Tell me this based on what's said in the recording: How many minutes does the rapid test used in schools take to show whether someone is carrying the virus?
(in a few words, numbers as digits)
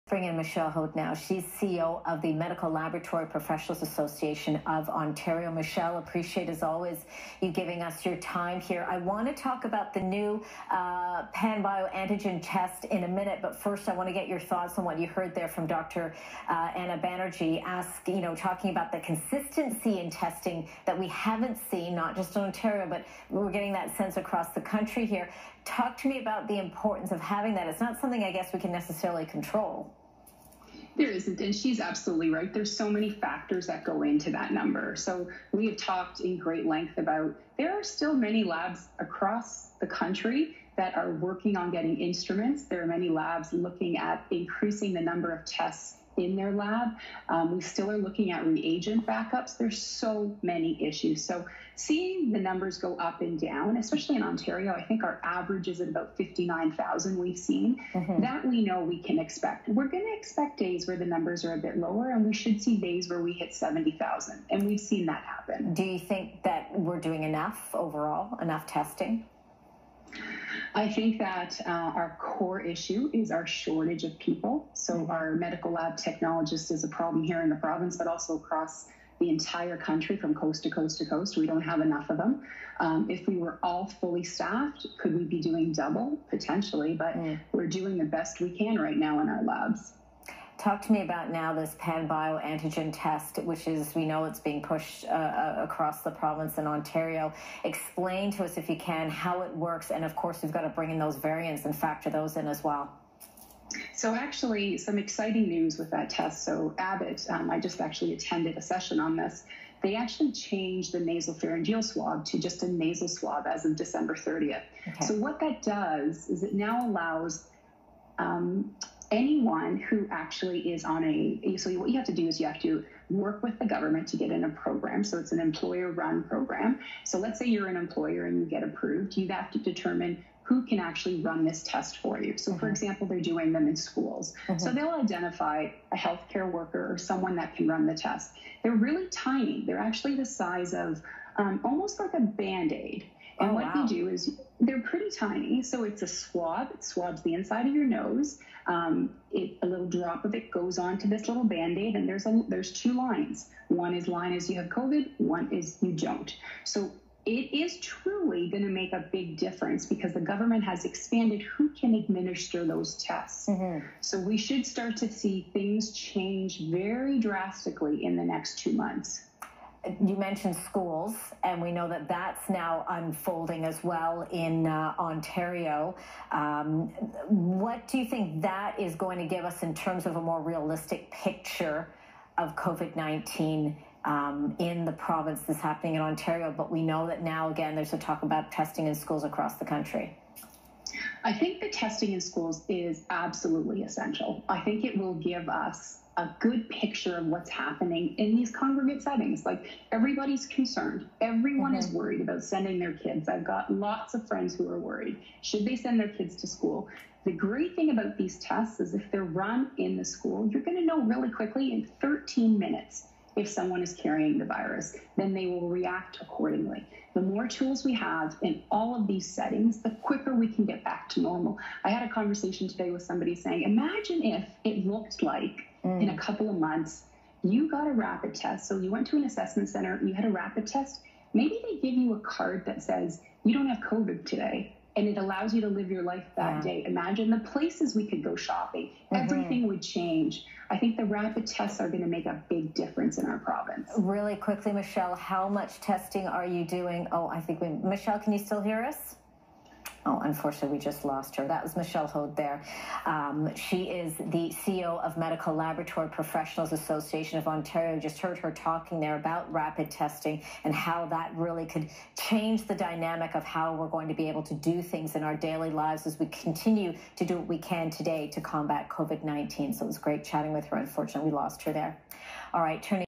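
13.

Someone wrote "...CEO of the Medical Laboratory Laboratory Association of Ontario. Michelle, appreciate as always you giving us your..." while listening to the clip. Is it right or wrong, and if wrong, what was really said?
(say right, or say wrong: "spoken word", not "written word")
wrong: "Professionals", not "Laboratory".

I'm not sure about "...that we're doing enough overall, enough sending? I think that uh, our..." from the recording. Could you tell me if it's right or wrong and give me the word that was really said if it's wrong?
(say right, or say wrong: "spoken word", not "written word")
wrong: "testing", not "sending".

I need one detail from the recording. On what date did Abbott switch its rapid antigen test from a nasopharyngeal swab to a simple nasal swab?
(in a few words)
December 30.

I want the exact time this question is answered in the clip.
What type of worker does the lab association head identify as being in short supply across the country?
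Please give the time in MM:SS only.
01:15.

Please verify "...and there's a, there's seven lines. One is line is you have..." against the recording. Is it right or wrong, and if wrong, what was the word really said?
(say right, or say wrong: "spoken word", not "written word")
wrong: "two", not "seven".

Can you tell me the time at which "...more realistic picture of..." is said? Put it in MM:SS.
03:00.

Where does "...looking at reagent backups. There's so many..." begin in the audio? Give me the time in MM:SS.
00:47.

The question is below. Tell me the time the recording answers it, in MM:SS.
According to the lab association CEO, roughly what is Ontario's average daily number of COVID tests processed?
00:56.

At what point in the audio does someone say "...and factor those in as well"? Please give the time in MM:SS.
01:41.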